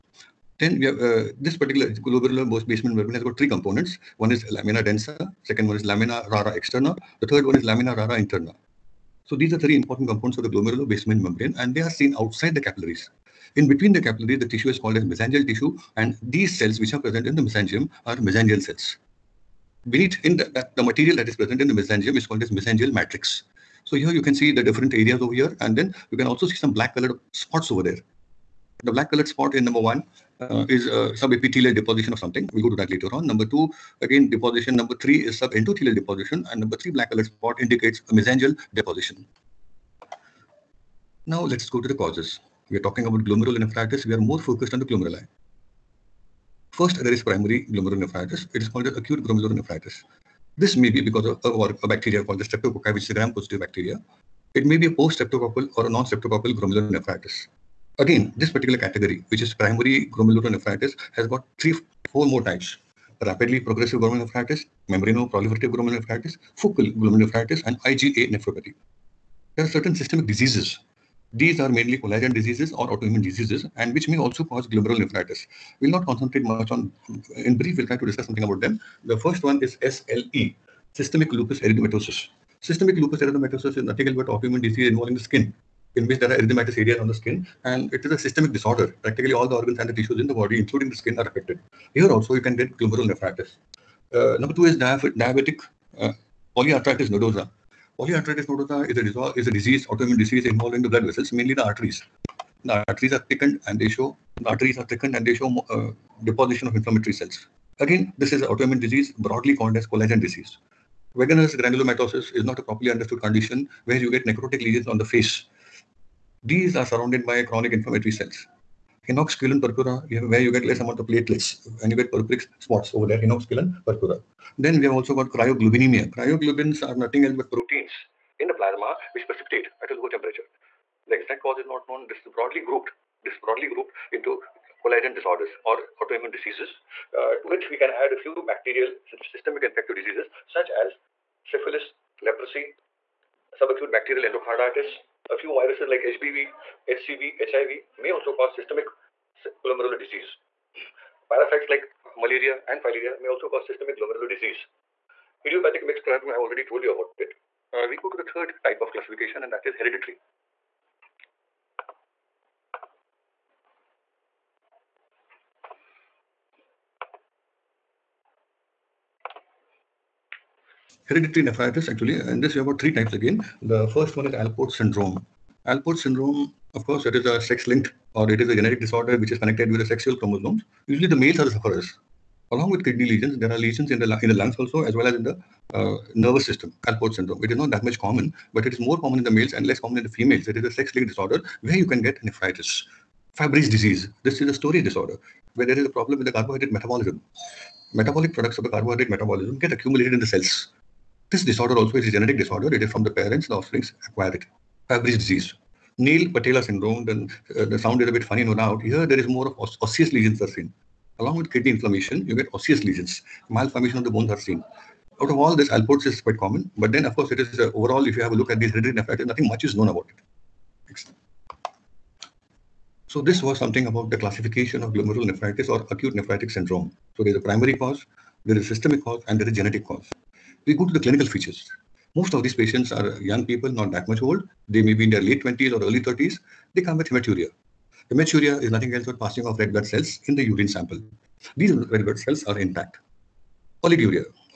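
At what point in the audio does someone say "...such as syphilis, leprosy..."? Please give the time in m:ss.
2:20.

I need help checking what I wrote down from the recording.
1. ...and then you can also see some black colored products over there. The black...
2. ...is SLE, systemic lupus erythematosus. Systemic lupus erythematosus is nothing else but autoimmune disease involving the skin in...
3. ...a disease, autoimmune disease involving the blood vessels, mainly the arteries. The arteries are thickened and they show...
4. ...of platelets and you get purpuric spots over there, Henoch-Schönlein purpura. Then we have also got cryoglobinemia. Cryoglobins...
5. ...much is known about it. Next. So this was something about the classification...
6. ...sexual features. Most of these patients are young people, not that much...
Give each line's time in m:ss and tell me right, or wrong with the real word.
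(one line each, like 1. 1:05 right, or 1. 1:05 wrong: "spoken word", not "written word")
1. 0:25 wrong: "spots", not "products"
2. 1:19 right
3. 1:39 right
4. 2:00 right
5. 3:39 right
6. 3:50 wrong: "clinical", not "sexual".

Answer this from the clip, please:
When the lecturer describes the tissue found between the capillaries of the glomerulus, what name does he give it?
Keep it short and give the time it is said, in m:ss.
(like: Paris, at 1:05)
mesangial tissue, at 0:15.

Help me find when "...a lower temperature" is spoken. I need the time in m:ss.
2:09.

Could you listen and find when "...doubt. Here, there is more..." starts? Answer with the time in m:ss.
3:28.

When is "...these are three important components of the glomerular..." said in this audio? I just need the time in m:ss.
0:09.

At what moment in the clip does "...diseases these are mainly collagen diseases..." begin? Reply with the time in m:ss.
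1:10.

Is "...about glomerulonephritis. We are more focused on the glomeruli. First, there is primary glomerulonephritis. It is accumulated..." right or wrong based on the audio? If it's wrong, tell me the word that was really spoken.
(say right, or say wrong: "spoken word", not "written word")
wrong: "called", not "accumulated".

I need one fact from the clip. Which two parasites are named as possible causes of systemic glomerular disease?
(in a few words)
malaria and filaria.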